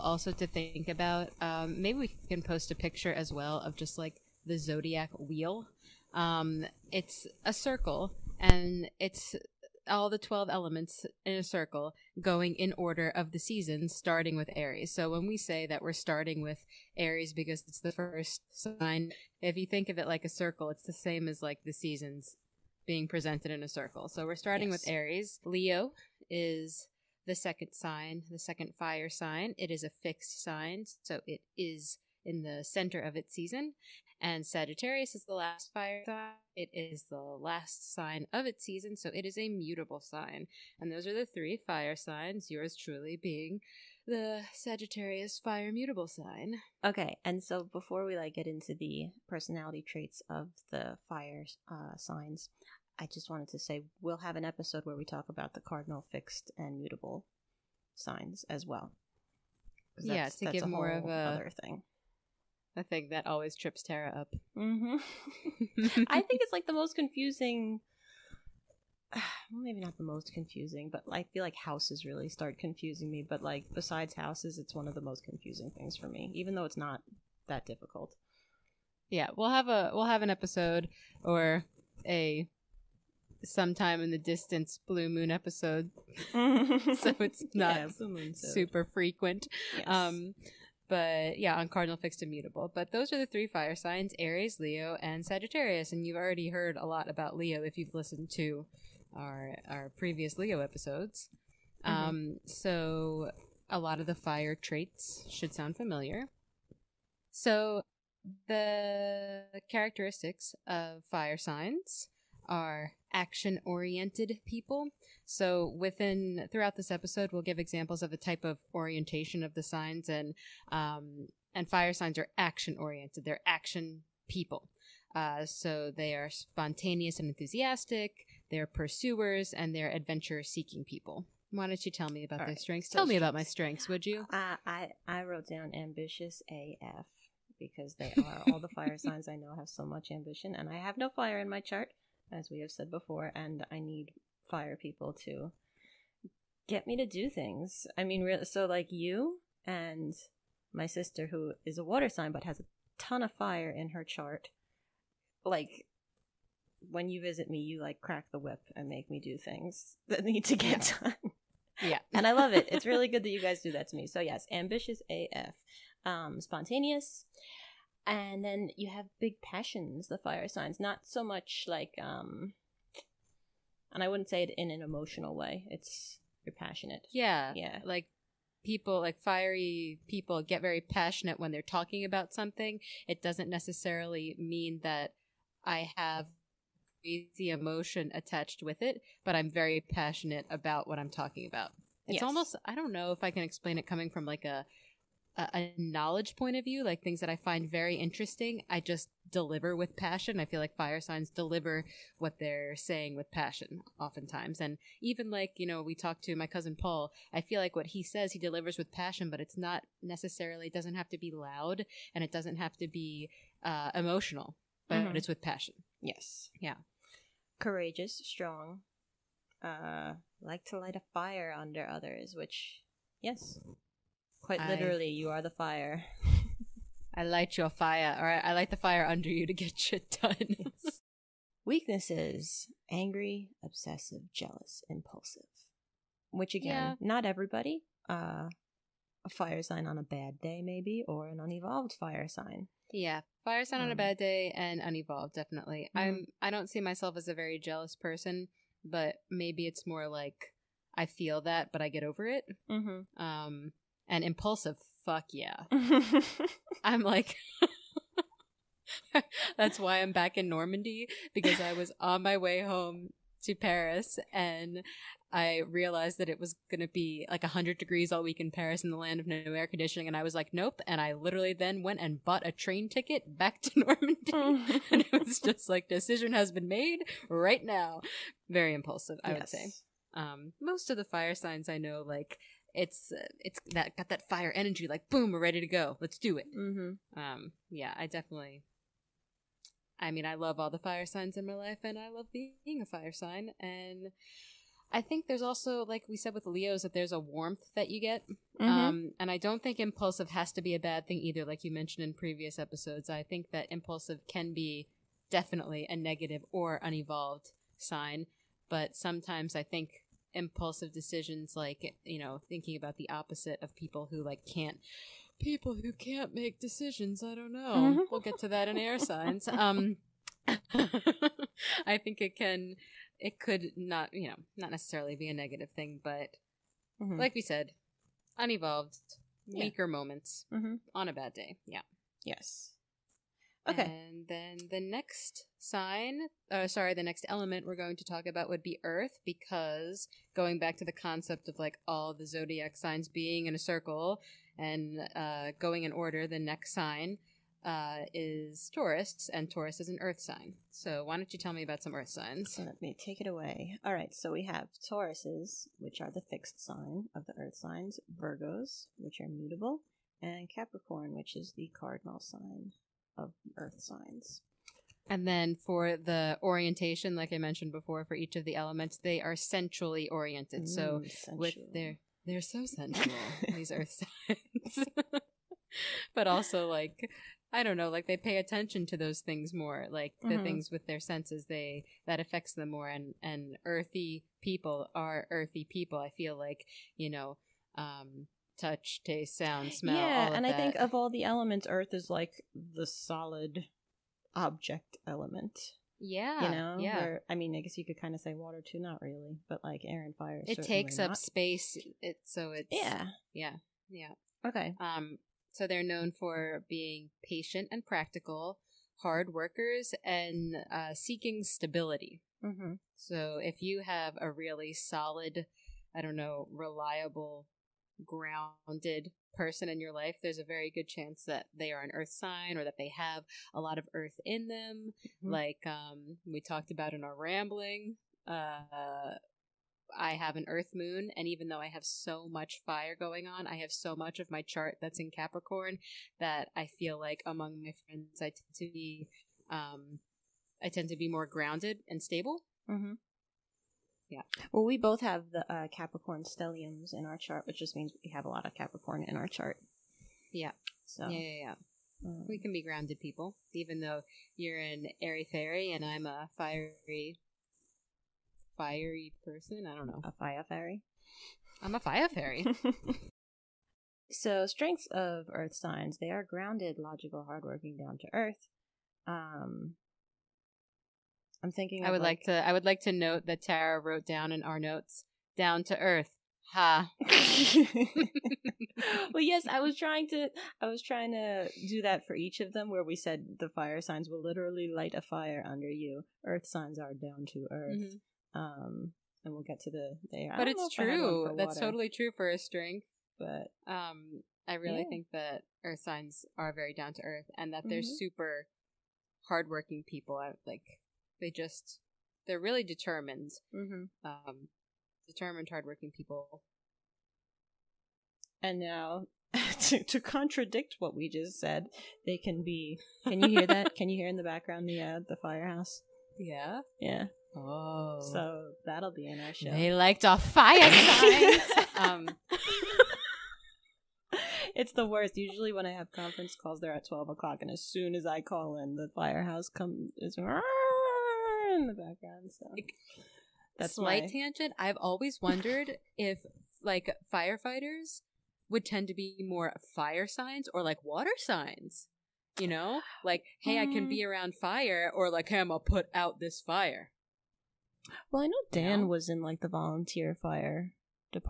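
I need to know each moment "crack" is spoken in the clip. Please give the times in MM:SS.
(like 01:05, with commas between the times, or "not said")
02:37.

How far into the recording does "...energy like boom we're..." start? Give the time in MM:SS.
04:44.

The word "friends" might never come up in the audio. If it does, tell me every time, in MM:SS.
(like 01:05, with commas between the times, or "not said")
07:17.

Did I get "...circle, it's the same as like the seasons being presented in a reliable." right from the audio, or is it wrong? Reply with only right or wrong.
wrong.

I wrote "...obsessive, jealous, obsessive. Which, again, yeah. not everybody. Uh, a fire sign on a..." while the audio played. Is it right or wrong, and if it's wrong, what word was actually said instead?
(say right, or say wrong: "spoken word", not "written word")
wrong: "impulsive", not "obsessive".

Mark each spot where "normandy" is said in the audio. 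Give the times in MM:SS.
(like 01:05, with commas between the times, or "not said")
04:20, 04:33.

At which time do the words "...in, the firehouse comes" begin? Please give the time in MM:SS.
08:48.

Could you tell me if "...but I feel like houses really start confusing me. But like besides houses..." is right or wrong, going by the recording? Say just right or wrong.
right.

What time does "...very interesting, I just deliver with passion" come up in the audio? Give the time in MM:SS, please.
03:17.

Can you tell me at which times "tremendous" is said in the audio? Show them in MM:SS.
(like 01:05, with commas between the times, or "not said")
not said.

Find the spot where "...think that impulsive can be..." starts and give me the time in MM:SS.
05:03.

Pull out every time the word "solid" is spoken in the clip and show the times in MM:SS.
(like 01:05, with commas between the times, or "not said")
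06:32, 06:54.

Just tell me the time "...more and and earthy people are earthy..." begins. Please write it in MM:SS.
06:22.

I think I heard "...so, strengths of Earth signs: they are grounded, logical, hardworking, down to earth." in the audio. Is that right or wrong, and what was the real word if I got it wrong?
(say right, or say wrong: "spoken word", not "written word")
right.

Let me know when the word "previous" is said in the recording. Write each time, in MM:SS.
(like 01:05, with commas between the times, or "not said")
01:39, 05:02.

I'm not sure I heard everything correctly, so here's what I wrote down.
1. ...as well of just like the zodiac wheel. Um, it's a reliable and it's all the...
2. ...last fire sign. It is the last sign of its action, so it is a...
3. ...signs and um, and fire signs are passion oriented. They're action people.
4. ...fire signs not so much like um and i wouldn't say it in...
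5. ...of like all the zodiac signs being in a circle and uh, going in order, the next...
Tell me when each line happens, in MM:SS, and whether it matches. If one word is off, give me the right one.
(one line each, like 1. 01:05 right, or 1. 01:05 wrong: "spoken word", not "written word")
1. 00:03 wrong: "circle", not "reliable"
2. 00:35 wrong: "season", not "action"
3. 01:59 wrong: "action", not "passion"
4. 02:50 right
5. 05:41 right.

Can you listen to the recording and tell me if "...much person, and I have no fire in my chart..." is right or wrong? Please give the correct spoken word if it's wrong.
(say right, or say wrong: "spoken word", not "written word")
wrong: "ambition", not "person".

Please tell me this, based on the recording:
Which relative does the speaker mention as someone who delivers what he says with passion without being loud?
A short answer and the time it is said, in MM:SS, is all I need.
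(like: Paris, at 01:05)
cousin Paul, at 03:26.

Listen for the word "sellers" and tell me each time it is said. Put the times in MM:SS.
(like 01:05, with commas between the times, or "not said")
not said.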